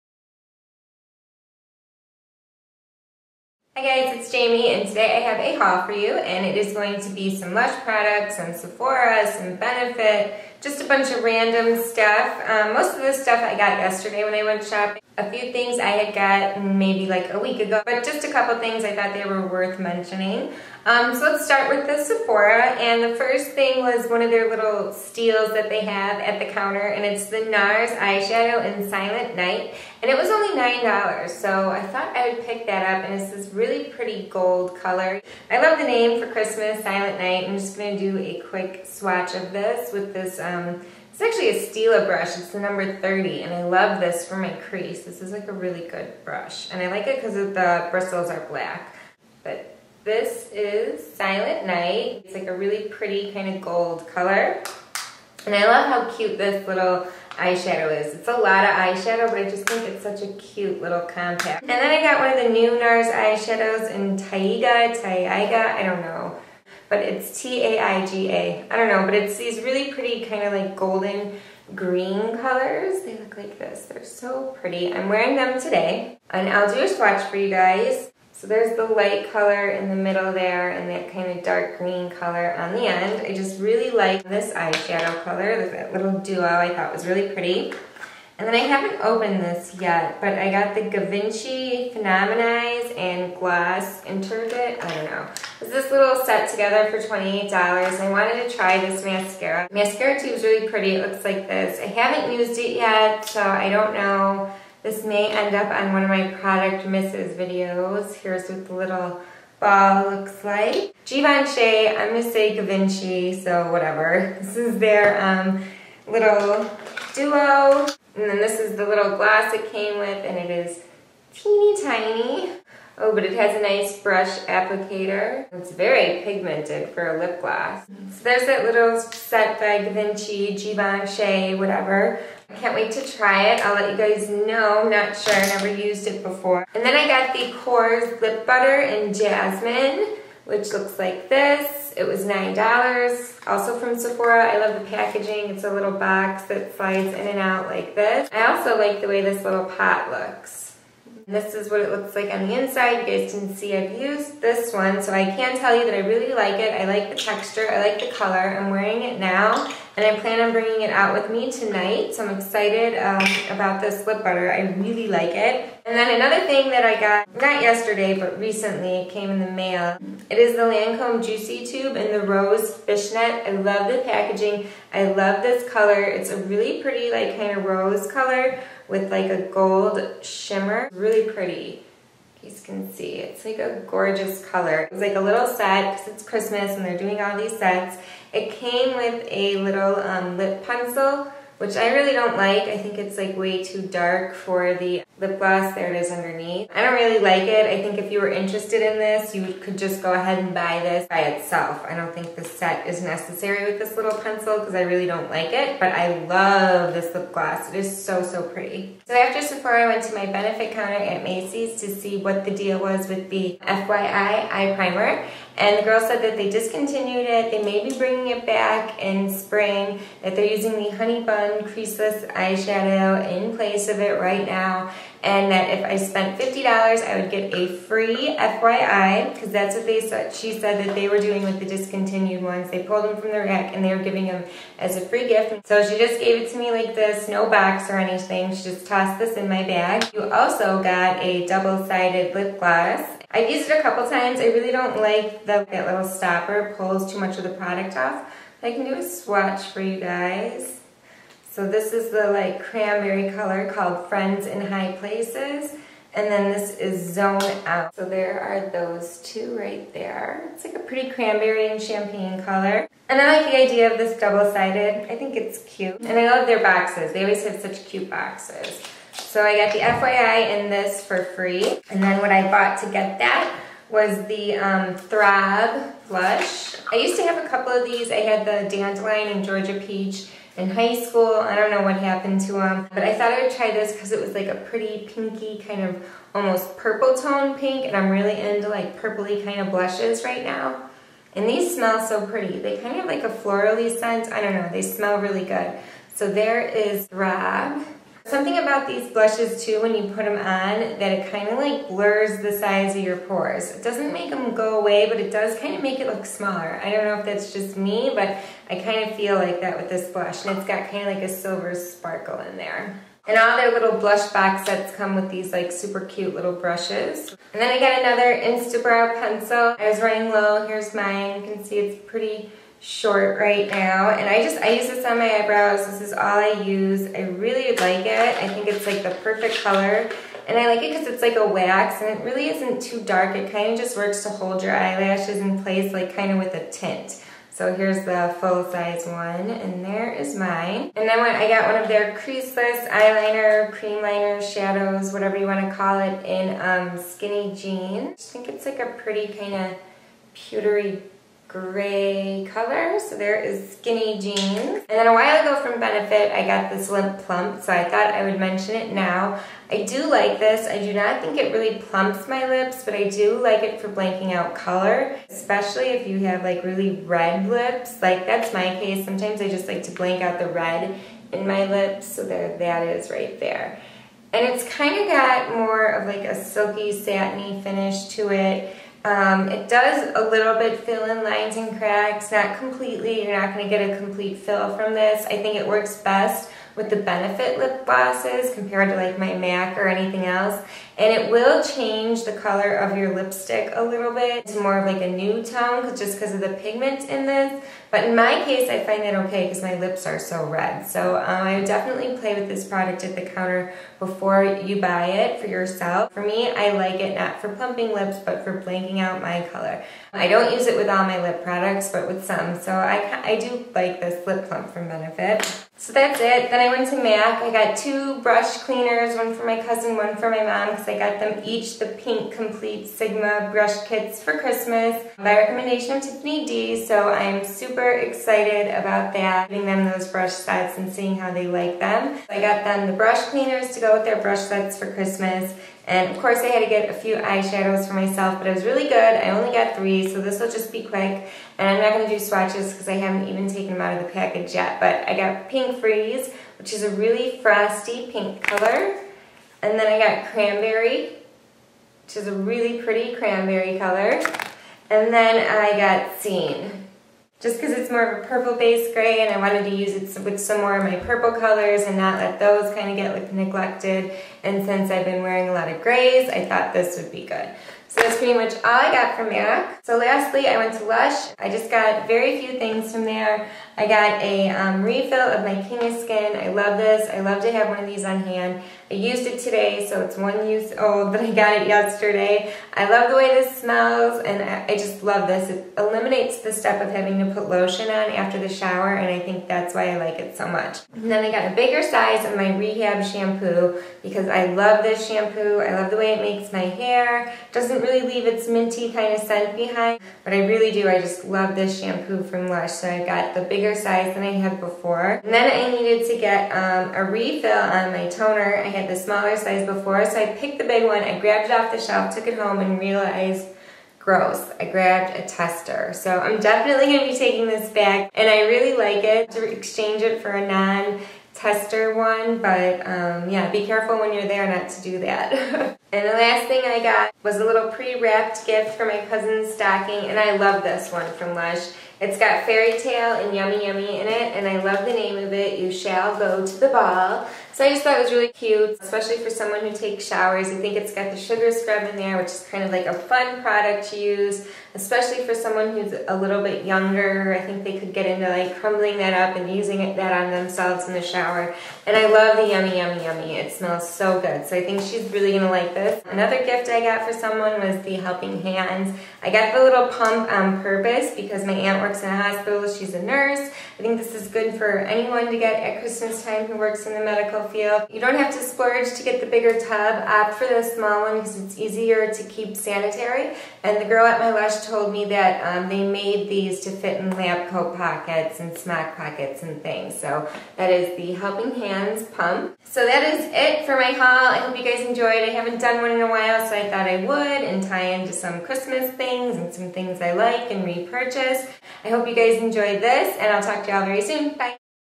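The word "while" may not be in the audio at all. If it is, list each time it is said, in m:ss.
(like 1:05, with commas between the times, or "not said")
5:55, 9:46.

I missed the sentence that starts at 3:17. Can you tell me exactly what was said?
I think if you were interested in this, you could just go ahead and buy this by itself.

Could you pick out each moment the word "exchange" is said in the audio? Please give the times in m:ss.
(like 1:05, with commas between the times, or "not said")
8:39.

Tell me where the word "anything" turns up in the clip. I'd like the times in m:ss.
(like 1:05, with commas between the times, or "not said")
3:57, 6:29.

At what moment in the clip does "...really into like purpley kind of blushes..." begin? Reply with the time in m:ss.
4:48.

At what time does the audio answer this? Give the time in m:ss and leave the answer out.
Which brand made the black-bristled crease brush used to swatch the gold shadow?
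0:41.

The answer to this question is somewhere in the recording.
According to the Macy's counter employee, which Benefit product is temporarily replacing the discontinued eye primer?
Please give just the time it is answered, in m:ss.
3:40.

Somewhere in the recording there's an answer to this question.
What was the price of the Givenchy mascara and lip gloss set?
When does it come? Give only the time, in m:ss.
1:37.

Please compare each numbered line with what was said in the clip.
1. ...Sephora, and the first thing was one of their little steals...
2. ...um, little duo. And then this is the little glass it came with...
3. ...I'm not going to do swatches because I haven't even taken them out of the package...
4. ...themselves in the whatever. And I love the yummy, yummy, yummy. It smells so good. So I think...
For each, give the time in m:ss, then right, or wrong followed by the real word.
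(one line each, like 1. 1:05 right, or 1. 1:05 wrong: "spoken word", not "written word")
1. 0:22 right
2. 1:55 right
3. 7:21 right
4. 9:10 wrong: "shower", not "whatever".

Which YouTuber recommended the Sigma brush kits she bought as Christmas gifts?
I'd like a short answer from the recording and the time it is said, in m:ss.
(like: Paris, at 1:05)
Tiffany D, at 7:06.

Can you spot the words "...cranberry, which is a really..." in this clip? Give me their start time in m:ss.
7:30.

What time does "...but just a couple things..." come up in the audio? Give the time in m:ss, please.
0:17.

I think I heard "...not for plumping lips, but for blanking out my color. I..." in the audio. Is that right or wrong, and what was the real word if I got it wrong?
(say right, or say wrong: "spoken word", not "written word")
right.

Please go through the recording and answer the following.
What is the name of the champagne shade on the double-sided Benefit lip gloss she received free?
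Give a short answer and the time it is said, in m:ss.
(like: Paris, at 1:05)
Zone Out, at 4:17.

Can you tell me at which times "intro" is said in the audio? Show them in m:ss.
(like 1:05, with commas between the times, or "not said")
not said.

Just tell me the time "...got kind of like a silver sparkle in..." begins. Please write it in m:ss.
5:10.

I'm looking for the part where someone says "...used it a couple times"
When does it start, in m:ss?
4:03.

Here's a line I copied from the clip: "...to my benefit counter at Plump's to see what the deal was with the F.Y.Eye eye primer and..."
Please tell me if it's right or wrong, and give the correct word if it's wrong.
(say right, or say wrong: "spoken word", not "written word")
wrong: "Macy", not "Plump".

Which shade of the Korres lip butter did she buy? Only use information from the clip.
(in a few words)
Jasmine.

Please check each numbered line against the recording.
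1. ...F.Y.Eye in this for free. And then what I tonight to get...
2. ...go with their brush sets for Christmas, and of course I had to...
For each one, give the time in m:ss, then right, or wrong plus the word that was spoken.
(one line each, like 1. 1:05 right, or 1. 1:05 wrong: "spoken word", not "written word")
1. 4:29 wrong: "bought", not "tonight"
2. 7:13 right.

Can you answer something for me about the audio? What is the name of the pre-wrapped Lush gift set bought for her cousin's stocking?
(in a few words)
You Shall Go to the Ball.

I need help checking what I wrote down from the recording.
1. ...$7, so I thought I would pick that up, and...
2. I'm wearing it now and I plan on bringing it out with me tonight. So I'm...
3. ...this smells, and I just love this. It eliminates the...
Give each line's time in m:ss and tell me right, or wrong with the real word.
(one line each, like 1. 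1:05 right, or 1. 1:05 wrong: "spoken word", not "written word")
1. 0:30 wrong: "9", not "7"
2. 2:38 right
3. 8:03 right.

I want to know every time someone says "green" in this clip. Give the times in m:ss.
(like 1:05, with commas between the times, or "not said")
1:11, 1:21.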